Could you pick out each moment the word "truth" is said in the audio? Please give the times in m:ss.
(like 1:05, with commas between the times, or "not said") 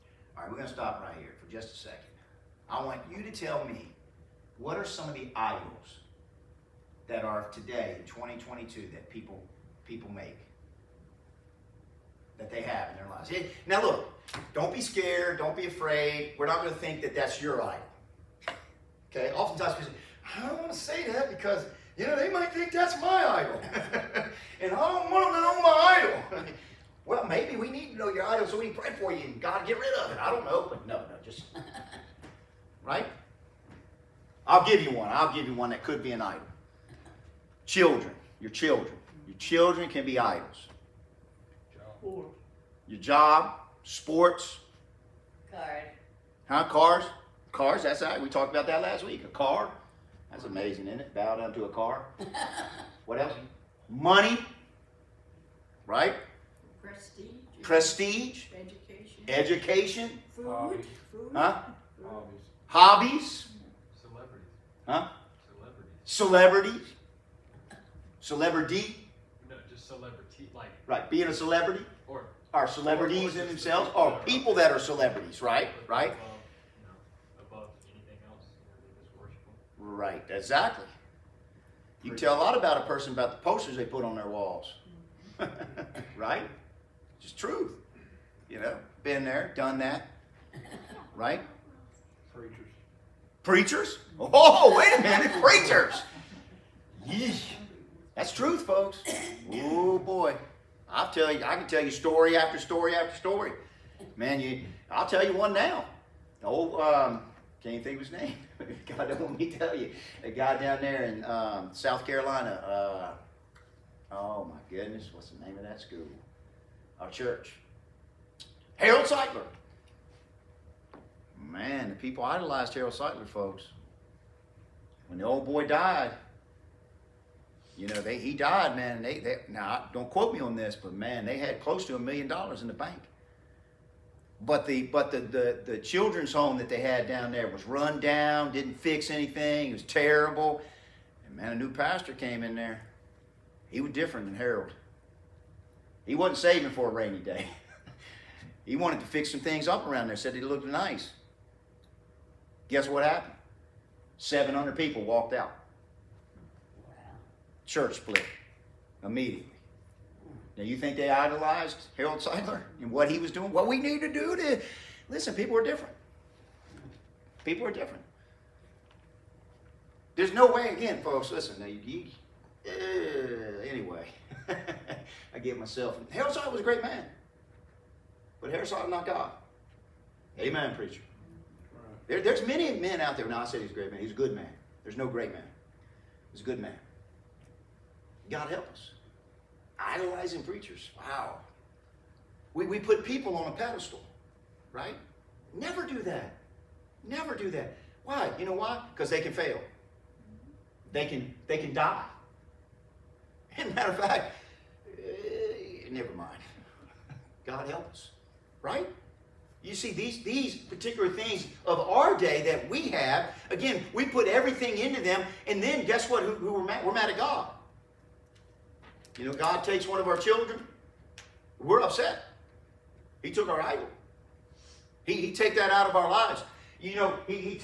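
1:27, 1:38.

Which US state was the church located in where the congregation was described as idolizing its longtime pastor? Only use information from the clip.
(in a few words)
South Carolina.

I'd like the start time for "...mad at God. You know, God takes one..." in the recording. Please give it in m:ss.
3:36.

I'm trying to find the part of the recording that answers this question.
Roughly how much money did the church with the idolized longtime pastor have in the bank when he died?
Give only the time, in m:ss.
2:11.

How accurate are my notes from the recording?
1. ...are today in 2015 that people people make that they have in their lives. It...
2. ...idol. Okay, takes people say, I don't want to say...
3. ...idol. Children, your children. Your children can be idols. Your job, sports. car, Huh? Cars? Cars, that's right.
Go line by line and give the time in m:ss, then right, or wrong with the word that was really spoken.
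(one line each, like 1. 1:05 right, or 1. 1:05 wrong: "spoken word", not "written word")
1. 0:07 wrong: "2022", not "2015"
2. 0:17 wrong: "oftentimes", not "takes"
3. 0:36 right.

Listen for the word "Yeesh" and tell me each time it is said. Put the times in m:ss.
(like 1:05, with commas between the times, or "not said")
1:37.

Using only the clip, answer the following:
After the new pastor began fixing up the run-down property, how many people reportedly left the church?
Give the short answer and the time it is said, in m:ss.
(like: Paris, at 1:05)
700, at 2:34.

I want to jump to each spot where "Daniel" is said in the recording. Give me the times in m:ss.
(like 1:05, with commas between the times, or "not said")
not said.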